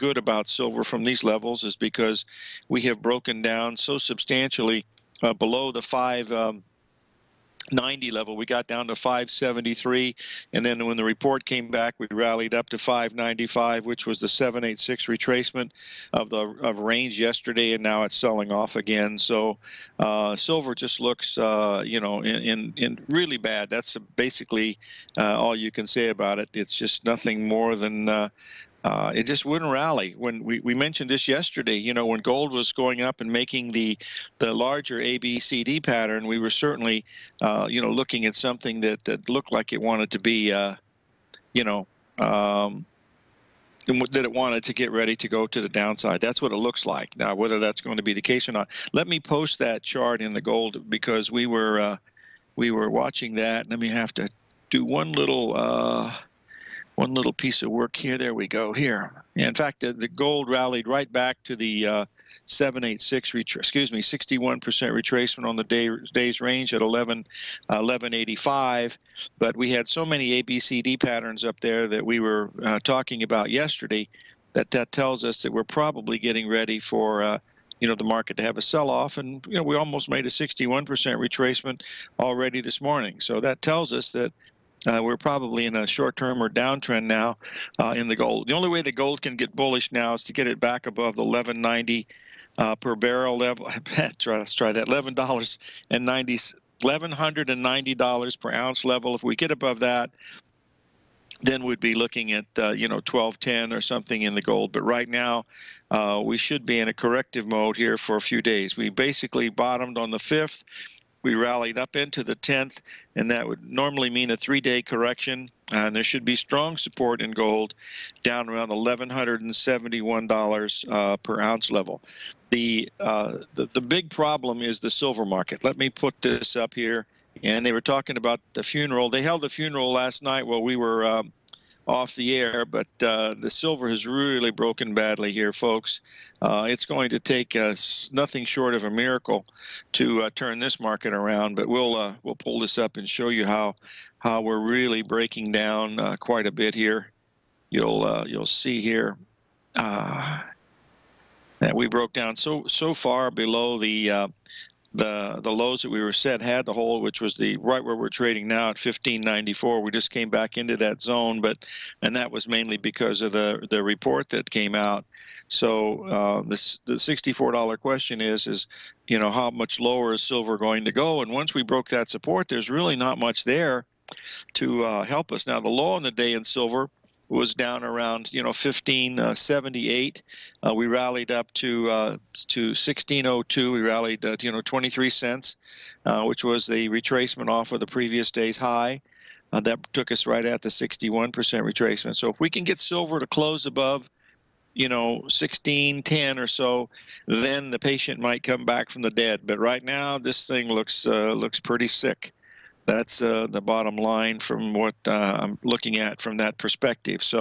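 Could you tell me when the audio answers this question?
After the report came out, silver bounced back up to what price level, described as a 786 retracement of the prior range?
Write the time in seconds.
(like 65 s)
12 s.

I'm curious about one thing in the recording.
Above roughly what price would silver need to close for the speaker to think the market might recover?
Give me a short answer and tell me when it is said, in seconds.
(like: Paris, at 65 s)
1610, at 195 s.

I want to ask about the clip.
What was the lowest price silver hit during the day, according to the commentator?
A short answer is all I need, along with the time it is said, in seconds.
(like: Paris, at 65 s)
1578, at 178 s.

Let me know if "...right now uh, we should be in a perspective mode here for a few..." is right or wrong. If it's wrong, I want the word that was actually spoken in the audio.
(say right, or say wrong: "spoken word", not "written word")
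wrong: "corrective", not "perspective".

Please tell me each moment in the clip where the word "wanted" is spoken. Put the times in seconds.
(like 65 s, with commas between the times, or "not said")
39 s, 44 s.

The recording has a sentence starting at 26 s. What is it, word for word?
It's just nothing more than uh, uh, it just wouldn't rally.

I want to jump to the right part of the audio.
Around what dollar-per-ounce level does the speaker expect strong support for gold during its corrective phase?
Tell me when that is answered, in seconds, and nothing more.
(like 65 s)
118 s.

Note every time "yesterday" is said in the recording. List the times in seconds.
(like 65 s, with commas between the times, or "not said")
17 s, 31 s, 73 s.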